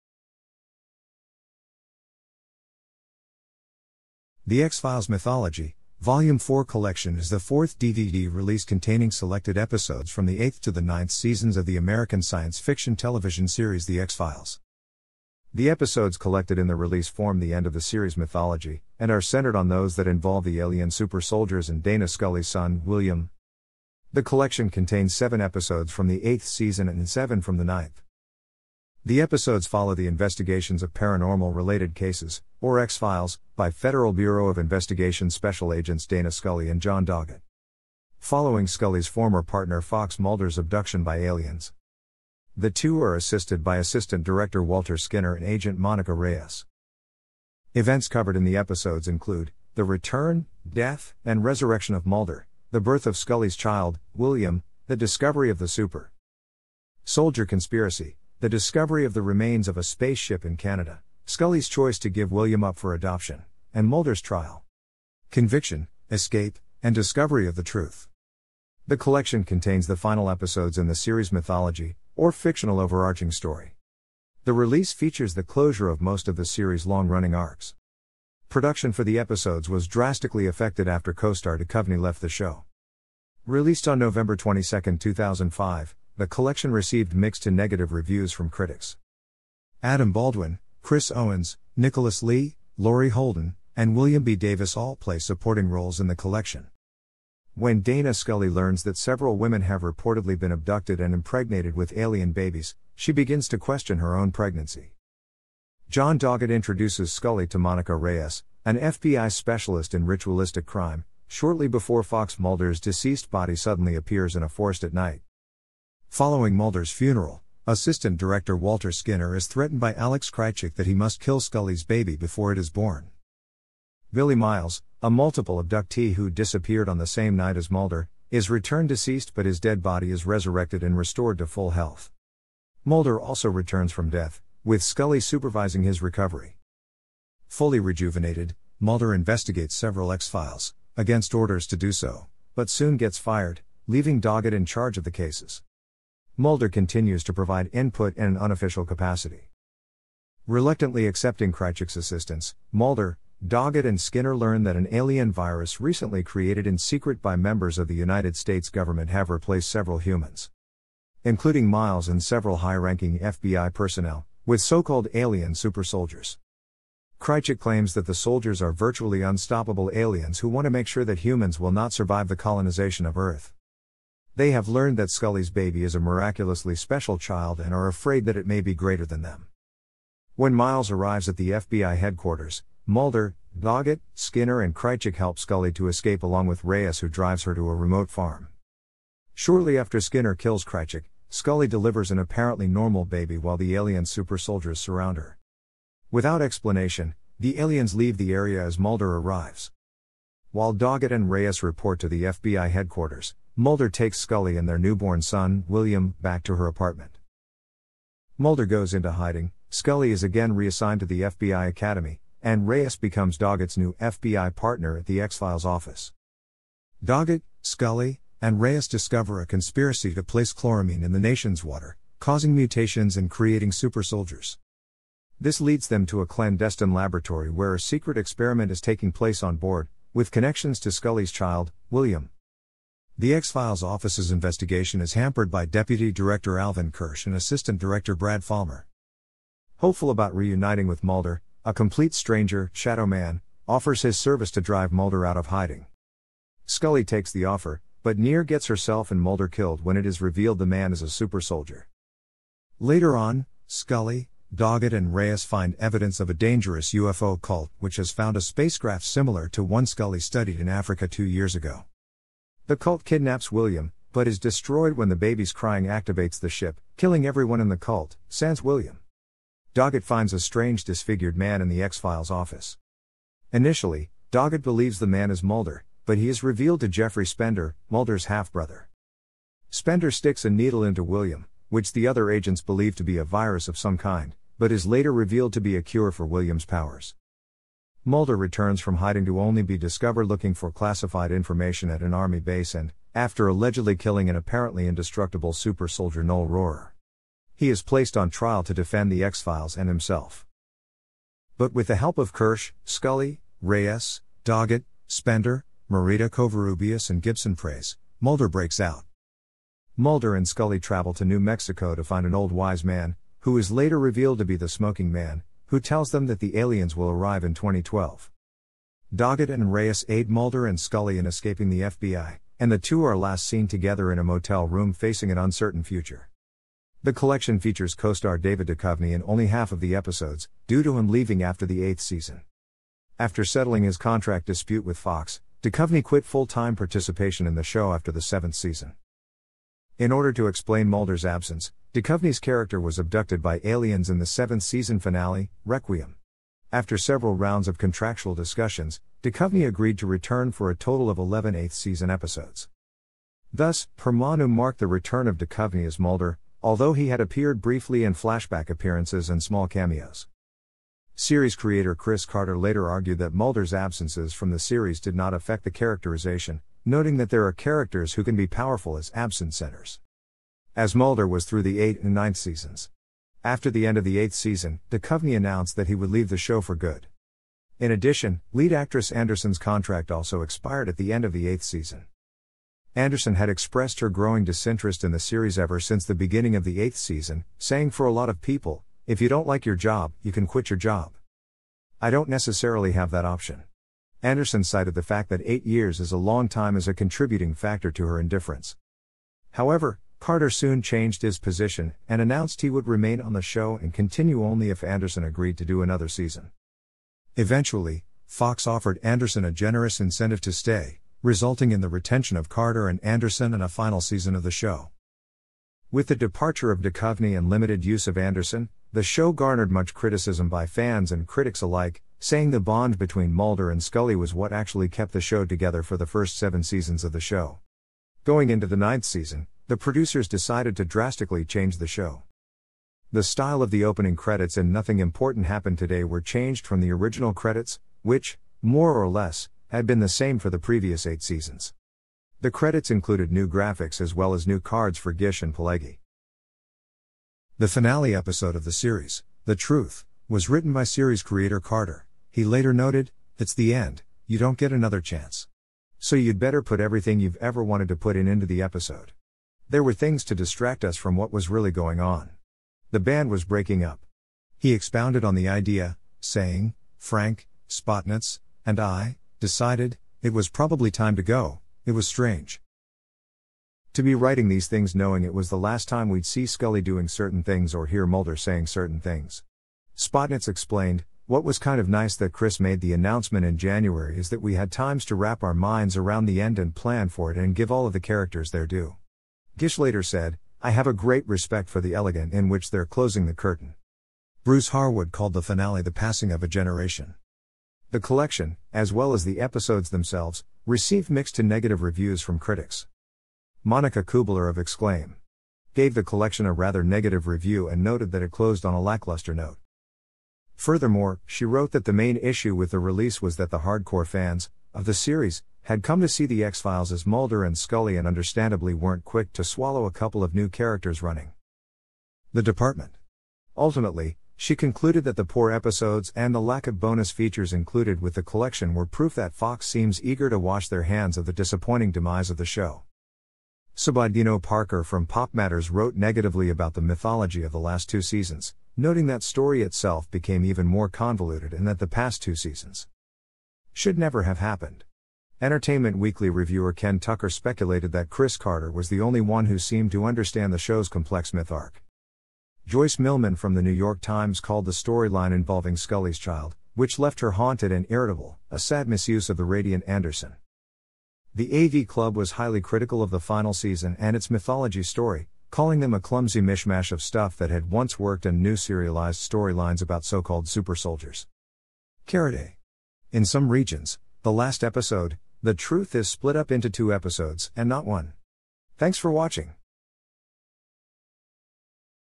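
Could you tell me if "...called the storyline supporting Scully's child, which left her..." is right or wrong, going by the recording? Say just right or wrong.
wrong.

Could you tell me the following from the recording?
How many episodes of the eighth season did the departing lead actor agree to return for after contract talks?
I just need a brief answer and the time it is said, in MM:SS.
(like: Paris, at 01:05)
11, at 05:51.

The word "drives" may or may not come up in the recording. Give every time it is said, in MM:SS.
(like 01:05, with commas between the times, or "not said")
03:07, 04:04.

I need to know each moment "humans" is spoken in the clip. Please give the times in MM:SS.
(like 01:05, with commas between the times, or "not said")
02:39, 02:51.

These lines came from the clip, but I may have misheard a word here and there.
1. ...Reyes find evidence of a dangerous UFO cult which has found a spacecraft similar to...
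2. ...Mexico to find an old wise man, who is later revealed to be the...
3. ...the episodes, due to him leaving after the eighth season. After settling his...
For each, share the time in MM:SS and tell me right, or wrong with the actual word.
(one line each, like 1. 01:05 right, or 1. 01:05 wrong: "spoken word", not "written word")
1. 04:15 right
2. 05:11 right
3. 05:29 right.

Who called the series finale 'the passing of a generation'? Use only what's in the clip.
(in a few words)
Bruce Harwood.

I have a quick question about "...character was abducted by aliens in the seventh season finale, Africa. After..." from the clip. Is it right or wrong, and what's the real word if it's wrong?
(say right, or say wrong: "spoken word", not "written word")
wrong: "Requiem", not "Africa".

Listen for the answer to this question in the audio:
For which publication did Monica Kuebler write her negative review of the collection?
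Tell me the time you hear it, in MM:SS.
08:24.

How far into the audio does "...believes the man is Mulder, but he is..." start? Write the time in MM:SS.
04:34.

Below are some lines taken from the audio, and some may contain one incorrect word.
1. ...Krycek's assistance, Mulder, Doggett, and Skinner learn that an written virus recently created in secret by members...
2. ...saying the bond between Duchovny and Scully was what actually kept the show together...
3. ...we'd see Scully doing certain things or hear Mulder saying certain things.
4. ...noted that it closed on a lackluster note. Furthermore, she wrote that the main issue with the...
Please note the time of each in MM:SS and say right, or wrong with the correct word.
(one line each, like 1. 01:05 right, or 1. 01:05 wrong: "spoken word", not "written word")
1. 02:31 wrong: "alien", not "written"
2. 07:02 wrong: "Mulder", not "Duchovny"
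3. 07:56 right
4. 08:27 right.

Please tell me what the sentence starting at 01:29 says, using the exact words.
Adam Baldwin, Chris Owens, Nicholas Lea, Laurie Holden, and William B.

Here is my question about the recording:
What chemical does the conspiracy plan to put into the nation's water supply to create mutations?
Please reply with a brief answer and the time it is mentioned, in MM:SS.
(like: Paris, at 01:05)
Chloramine, at 03:40.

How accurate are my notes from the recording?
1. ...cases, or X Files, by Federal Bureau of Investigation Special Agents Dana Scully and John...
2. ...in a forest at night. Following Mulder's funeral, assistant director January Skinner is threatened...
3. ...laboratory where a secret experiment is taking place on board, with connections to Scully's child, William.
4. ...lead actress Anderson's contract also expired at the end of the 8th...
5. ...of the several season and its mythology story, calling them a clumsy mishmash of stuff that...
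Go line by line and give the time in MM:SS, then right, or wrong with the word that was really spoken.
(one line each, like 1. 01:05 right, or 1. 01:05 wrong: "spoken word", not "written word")
1. 00:31 right
2. 01:54 wrong: "Walter", not "January"
3. 03:46 right
4. 06:18 right
5. 09:23 wrong: "final", not "several".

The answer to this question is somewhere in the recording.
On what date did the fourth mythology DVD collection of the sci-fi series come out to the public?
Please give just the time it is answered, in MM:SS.
01:23.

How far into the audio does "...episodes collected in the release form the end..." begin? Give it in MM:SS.
00:15.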